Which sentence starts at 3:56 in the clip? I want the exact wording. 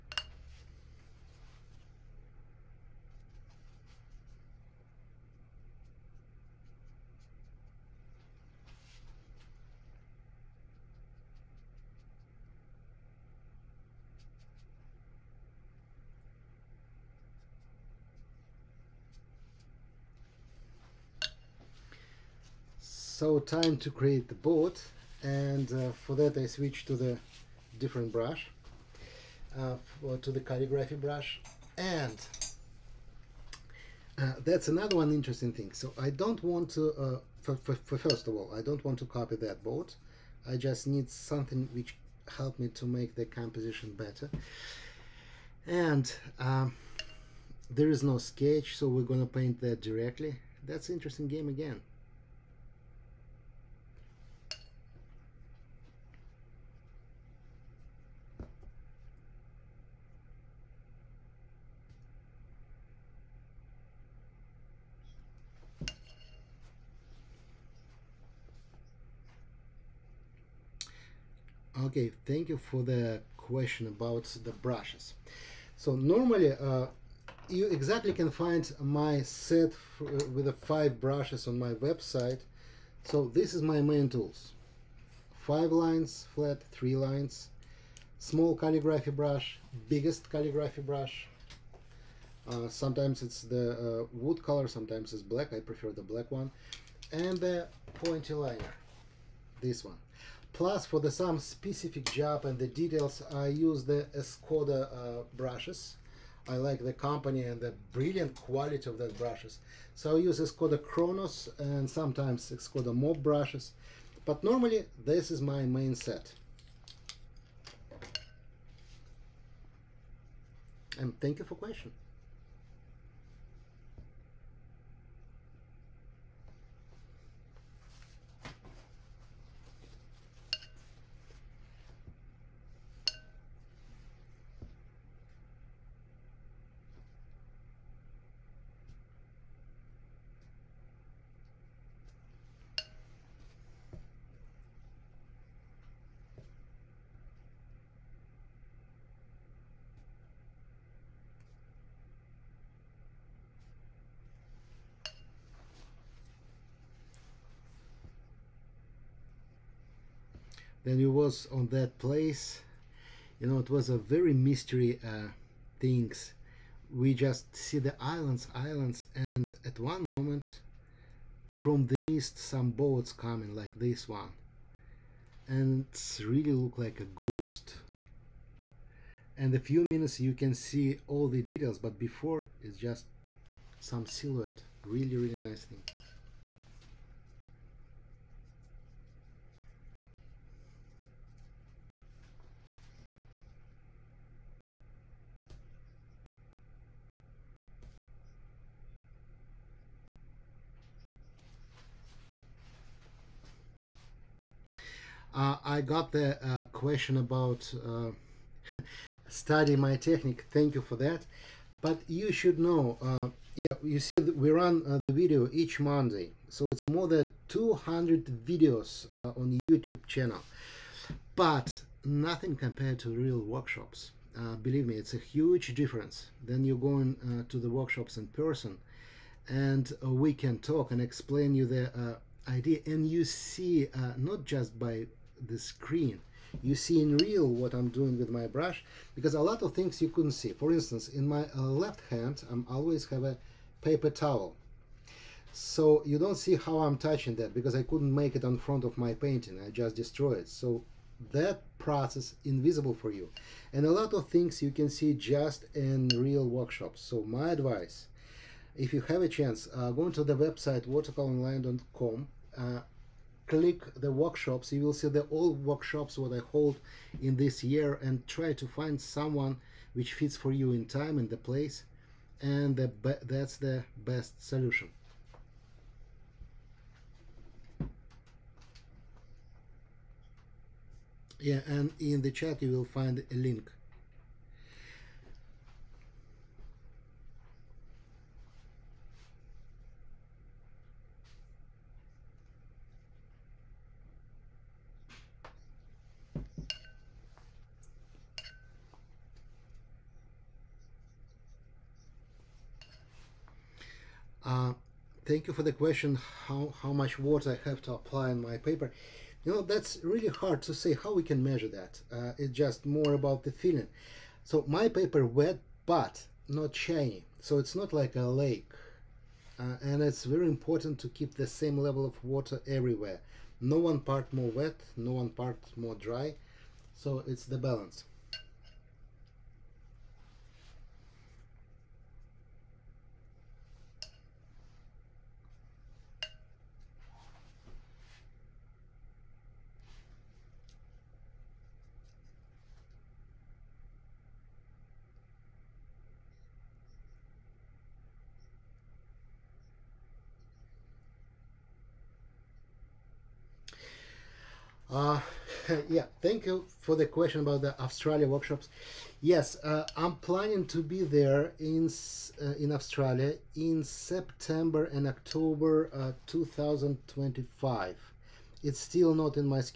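You see in real what I'm doing with my brush because a lot of things you couldn't see.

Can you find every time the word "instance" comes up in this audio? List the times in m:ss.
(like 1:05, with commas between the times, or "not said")
4:00.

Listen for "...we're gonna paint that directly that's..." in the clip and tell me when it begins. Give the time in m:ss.
0:48.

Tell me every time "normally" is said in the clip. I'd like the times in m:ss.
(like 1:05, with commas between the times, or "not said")
1:15, 1:54.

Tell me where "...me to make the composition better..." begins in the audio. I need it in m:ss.
0:42.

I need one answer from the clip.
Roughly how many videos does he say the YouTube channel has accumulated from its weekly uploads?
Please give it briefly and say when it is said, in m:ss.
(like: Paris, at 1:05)
more than 200, at 3:36.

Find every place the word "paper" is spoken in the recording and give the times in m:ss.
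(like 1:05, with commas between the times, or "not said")
4:03, 5:08, 5:14.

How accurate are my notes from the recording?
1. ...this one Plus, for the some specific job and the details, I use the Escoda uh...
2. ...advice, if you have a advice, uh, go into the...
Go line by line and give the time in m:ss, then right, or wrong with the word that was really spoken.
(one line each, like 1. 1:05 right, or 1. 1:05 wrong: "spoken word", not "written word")
1. 1:39 right
2. 4:17 wrong: "chance", not "advice".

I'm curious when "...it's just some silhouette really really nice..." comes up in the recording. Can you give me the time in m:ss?
3:02.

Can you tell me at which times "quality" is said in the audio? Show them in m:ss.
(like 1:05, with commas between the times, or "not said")
1:48.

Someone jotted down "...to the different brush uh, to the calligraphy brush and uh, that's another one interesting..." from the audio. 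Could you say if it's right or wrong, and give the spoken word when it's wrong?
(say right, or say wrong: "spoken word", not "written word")
right.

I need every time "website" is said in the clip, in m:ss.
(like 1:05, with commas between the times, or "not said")
1:21, 4:20.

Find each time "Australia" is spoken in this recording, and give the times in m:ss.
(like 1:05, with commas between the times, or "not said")
5:57, 6:02.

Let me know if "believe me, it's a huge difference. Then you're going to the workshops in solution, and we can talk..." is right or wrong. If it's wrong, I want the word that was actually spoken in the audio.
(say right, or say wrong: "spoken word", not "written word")
wrong: "person", not "solution".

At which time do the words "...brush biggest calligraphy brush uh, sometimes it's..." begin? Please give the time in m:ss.
1:29.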